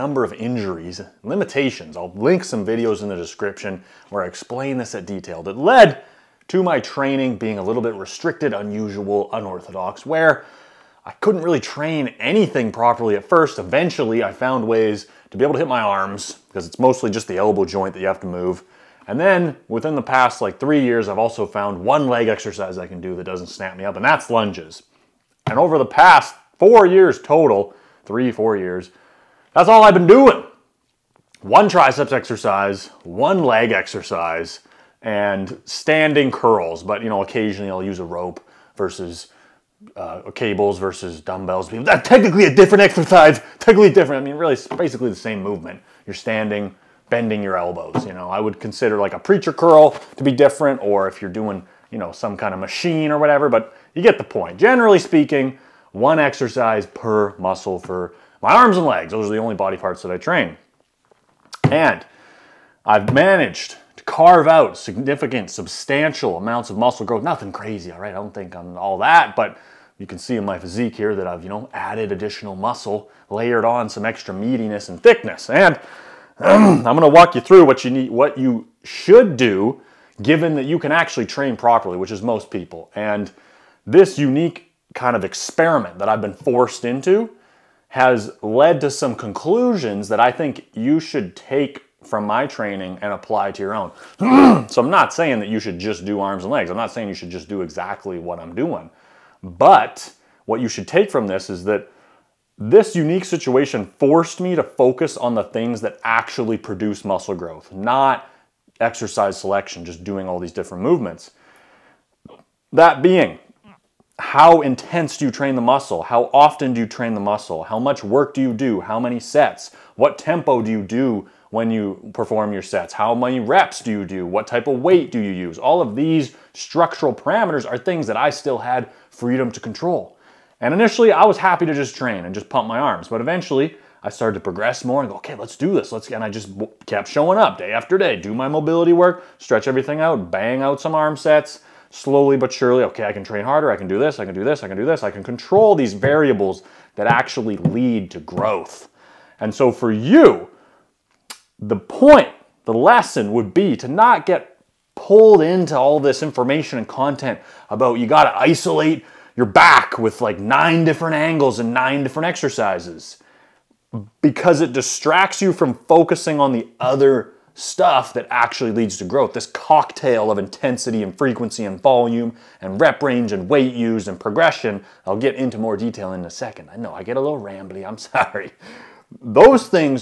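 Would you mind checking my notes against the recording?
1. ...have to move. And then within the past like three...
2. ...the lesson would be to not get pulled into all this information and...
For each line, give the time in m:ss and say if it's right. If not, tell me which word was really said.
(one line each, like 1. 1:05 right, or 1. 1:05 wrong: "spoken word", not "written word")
1. 0:18 right
2. 2:32 right.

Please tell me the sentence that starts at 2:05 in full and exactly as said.
All of these structural parameters are things that I still had freedom to control.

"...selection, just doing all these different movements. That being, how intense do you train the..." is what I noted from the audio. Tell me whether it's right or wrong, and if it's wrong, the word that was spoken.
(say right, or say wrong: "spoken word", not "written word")
right.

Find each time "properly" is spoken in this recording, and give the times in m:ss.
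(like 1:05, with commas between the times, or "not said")
0:12, 1:21.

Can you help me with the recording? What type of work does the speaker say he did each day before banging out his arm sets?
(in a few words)
mobility work.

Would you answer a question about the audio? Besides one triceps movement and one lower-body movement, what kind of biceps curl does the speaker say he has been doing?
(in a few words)
standing curls.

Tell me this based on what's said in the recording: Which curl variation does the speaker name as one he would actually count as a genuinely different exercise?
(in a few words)
preacher curl.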